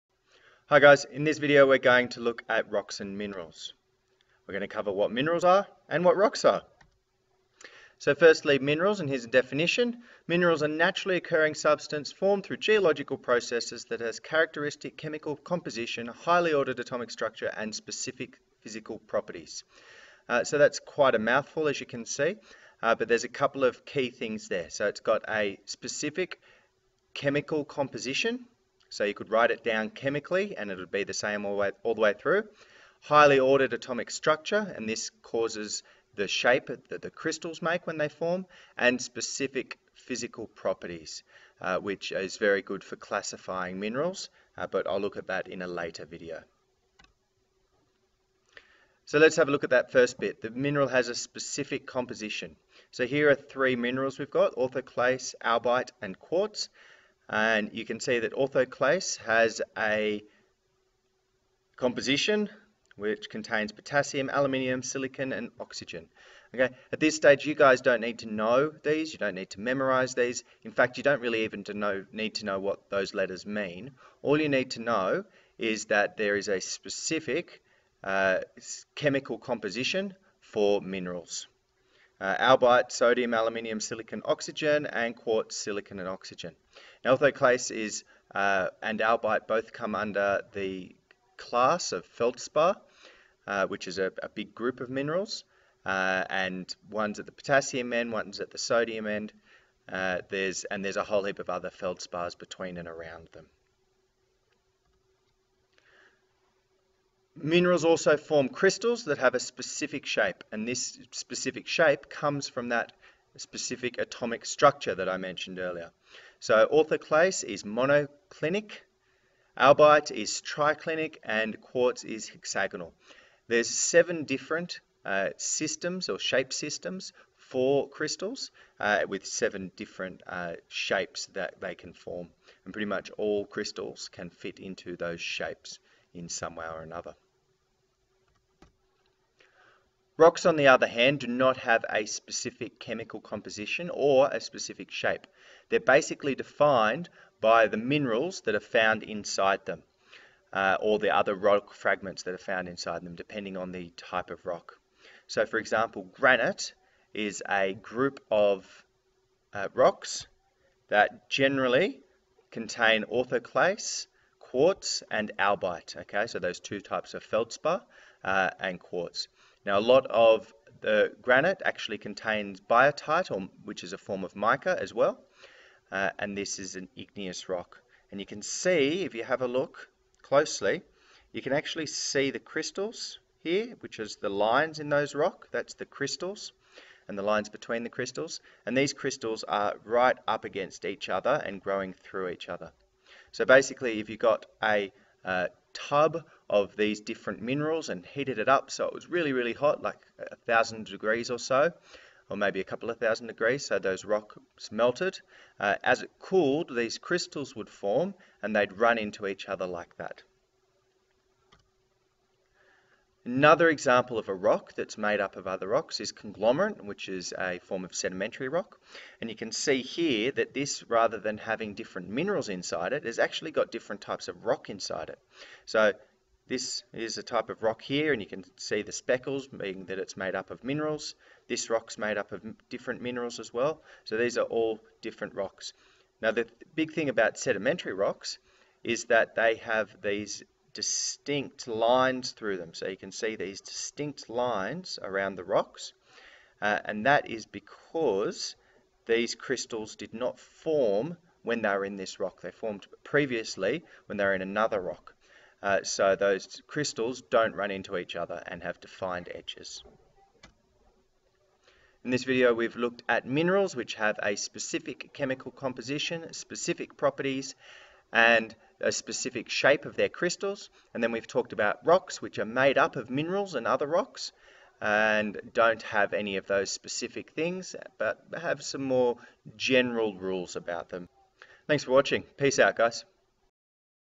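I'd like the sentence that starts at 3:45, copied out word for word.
So this is a type of rock here, and you can see the speckles, being that it's made up of minerals.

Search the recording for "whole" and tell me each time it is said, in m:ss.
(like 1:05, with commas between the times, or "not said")
1:41.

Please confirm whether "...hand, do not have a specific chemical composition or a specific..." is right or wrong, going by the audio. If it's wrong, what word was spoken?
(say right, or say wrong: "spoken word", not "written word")
right.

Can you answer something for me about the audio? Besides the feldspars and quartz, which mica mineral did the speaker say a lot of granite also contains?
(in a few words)
biotite.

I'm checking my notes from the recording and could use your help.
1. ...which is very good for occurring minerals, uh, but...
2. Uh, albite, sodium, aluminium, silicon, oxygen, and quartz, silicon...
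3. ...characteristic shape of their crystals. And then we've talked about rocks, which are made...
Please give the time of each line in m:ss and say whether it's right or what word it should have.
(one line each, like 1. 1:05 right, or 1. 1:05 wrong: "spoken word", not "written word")
1. 0:41 wrong: "classifying", not "occurring"
2. 1:22 right
3. 4:28 wrong: "specific", not "characteristic".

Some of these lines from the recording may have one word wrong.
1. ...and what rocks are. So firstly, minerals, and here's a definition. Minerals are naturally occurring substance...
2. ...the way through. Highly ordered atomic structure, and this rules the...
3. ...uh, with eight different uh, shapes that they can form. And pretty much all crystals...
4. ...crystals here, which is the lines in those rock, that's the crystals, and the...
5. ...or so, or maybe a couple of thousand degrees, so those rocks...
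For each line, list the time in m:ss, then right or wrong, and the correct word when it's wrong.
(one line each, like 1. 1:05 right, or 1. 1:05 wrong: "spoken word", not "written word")
1. 0:05 right
2. 0:31 wrong: "causes", not "rules"
3. 2:08 wrong: "seven", not "eight"
4. 3:02 right
5. 3:21 right.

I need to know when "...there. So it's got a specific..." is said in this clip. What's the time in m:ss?
0:24.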